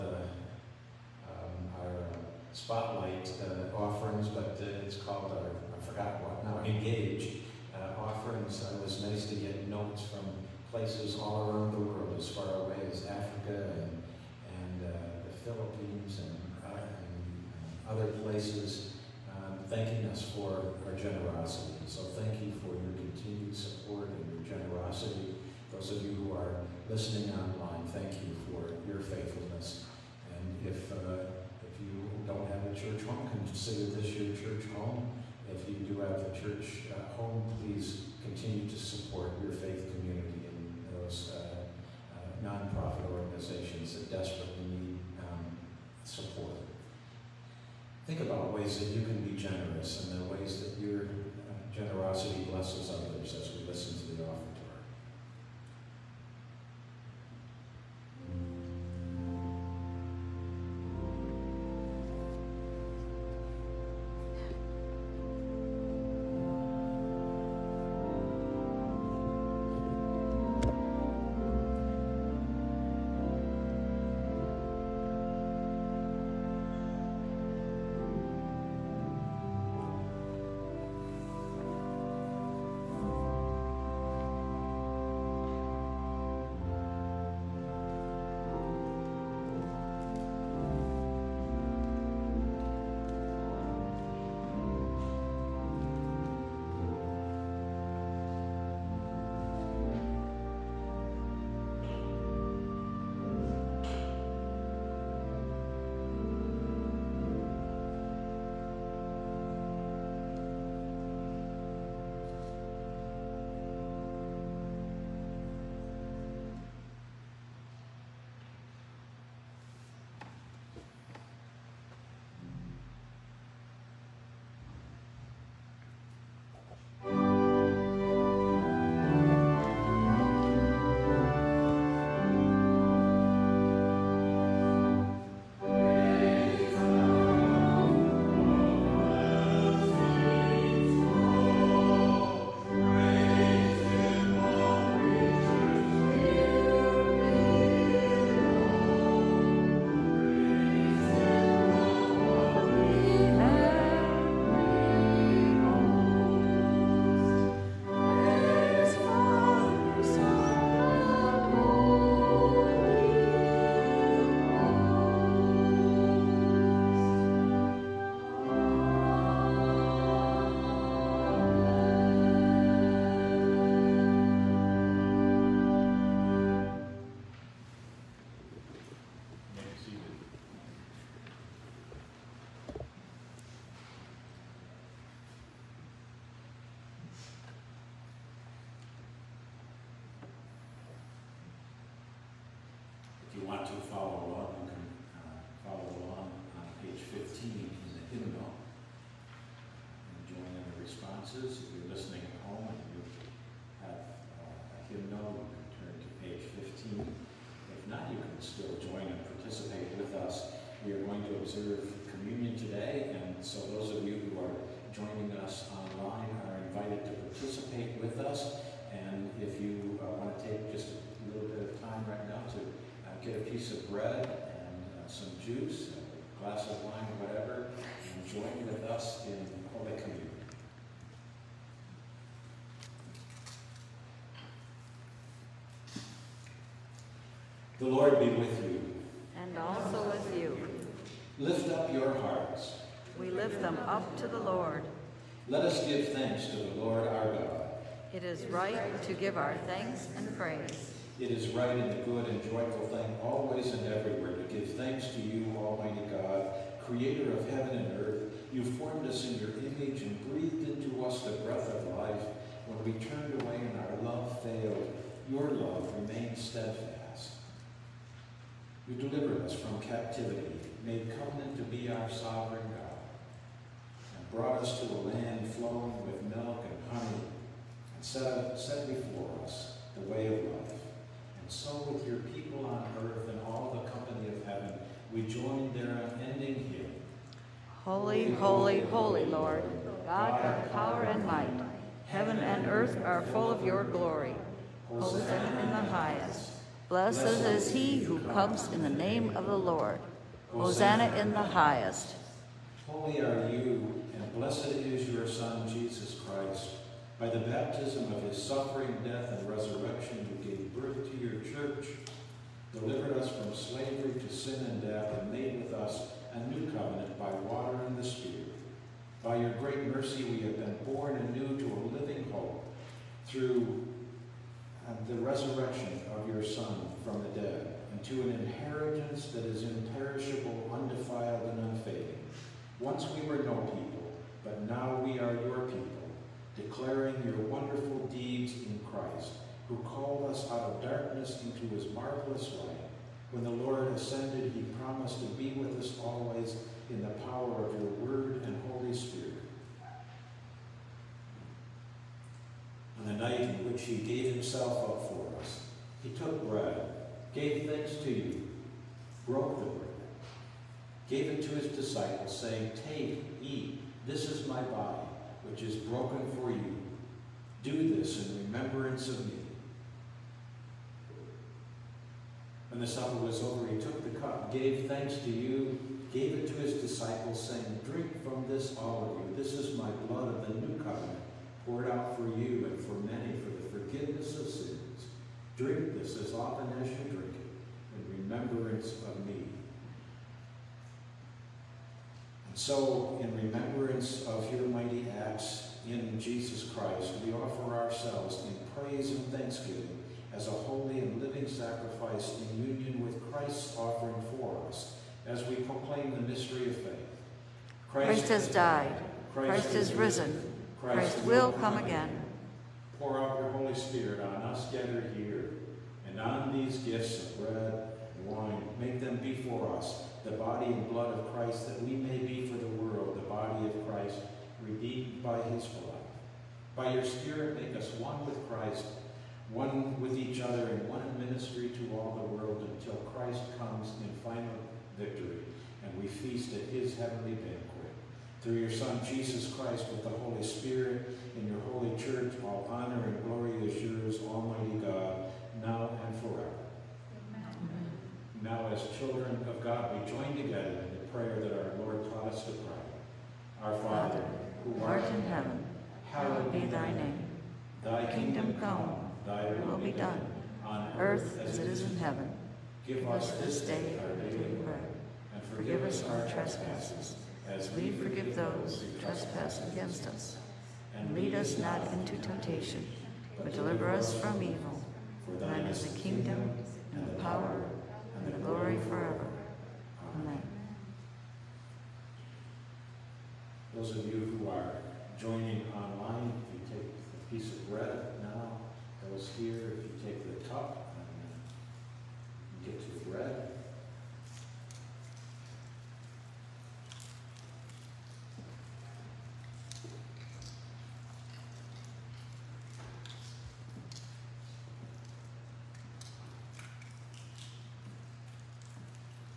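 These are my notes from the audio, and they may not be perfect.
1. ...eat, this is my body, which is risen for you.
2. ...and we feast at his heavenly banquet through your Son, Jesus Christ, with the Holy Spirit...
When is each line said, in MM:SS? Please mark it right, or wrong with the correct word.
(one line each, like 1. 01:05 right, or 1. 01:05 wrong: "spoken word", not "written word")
1. 06:03 wrong: "broken", not "risen"
2. 07:15 right.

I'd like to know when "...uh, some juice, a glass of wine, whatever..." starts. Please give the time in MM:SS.
03:45.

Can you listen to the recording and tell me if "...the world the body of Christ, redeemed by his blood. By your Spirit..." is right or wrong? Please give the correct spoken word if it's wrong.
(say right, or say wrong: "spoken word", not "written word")
right.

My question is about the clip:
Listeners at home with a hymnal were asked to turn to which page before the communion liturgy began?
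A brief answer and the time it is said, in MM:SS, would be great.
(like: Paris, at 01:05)
15, at 03:26.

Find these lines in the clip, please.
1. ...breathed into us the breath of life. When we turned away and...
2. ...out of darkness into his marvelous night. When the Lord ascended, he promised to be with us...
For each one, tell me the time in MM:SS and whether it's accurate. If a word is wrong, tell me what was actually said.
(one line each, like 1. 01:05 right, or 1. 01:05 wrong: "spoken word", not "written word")
1. 04:20 right
2. 05:40 wrong: "light", not "night".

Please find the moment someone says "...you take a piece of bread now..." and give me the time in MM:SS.
08:06.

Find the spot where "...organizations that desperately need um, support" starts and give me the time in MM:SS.
00:43.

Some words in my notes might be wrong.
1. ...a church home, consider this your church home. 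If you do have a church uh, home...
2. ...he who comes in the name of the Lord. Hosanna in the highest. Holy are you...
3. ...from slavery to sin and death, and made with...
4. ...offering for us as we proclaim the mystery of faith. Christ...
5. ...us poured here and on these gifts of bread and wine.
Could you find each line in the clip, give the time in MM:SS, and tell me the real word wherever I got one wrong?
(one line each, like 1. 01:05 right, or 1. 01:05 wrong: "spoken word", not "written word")
1. 00:32 right
2. 04:57 right
3. 05:13 right
4. 06:43 right
5. 06:54 wrong: "gathered", not "poured".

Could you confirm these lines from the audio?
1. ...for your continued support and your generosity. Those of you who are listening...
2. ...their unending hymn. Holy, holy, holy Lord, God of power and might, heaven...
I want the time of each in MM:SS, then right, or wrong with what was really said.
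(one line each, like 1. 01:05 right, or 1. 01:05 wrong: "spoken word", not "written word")
1. 00:22 right
2. 04:45 right.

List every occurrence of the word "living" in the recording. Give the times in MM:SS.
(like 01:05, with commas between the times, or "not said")
05:21, 06:41.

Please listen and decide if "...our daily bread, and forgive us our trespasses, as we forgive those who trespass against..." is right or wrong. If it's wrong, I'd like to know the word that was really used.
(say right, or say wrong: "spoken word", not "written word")
right.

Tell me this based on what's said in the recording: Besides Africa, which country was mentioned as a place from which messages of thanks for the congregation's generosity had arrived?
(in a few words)
the Philippines.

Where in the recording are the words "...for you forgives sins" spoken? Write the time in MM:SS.
06:22.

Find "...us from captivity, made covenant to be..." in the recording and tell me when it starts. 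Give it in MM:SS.
04:29.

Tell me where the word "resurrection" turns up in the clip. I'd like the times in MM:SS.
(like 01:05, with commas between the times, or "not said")
05:09, 05:25.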